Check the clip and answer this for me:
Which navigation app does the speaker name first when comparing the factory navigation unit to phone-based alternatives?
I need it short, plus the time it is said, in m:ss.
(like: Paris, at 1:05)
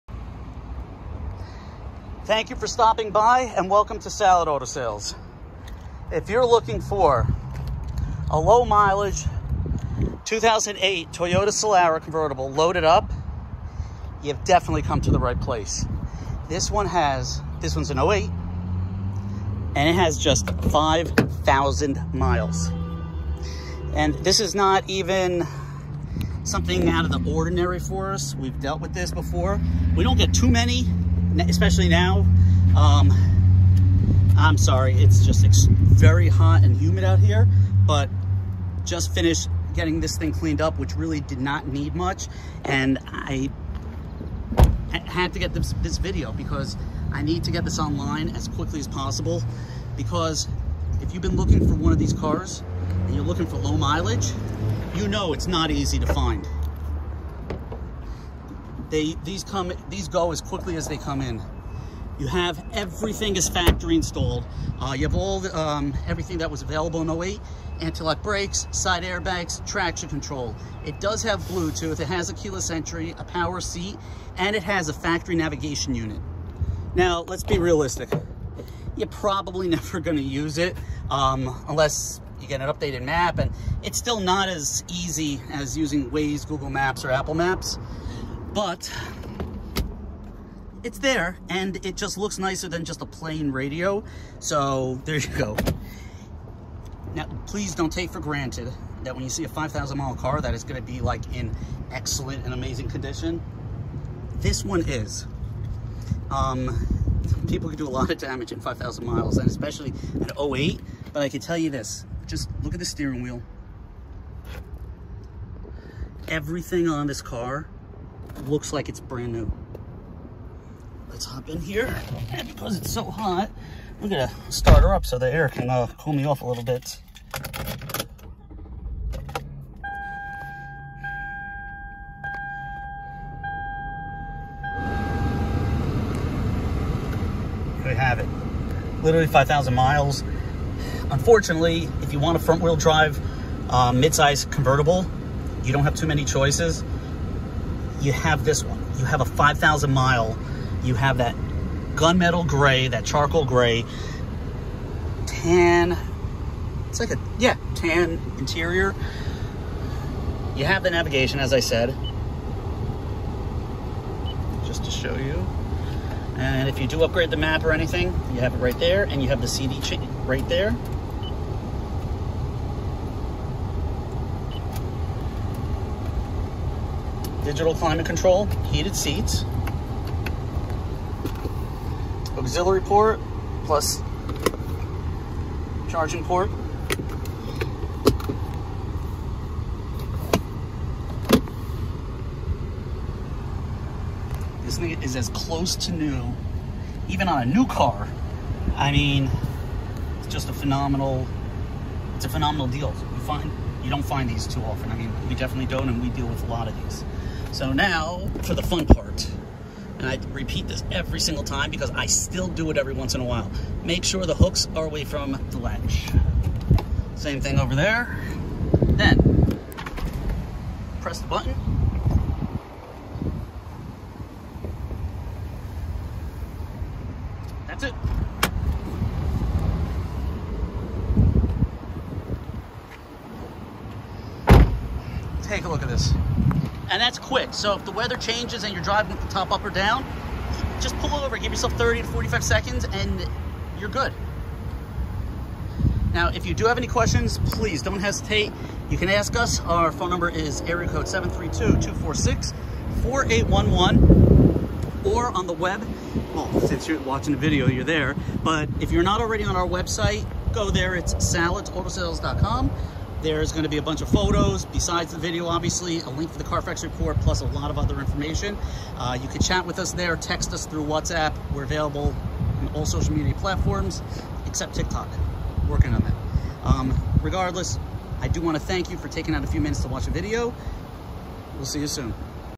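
Waze, at 1:26.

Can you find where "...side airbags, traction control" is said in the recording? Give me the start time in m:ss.
1:08.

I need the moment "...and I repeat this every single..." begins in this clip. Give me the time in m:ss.
3:29.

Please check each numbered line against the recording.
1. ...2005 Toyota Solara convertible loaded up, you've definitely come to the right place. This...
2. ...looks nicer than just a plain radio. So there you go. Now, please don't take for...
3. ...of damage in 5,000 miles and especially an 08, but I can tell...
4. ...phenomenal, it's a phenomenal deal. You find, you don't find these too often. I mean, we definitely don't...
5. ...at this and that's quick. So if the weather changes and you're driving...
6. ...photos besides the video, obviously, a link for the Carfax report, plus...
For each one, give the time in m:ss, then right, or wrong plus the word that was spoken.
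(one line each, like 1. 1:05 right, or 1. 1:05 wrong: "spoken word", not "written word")
1. 0:10 wrong: "2008", not "2005"
2. 1:32 right
3. 1:48 right
4. 3:20 right
5. 3:55 right
6. 4:24 right.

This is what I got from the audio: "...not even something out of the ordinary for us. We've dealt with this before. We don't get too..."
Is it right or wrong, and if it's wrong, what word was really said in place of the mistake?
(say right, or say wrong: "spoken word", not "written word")
right.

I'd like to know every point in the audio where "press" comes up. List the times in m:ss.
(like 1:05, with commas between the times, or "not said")
3:41.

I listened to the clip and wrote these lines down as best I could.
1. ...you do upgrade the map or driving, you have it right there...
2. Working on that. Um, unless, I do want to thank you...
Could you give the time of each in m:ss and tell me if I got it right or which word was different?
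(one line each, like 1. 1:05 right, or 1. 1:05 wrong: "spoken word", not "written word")
1. 2:46 wrong: "anything", not "driving"
2. 4:35 wrong: "regardless", not "unless".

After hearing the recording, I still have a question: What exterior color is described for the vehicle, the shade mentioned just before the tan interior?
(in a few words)
Charcoal gray.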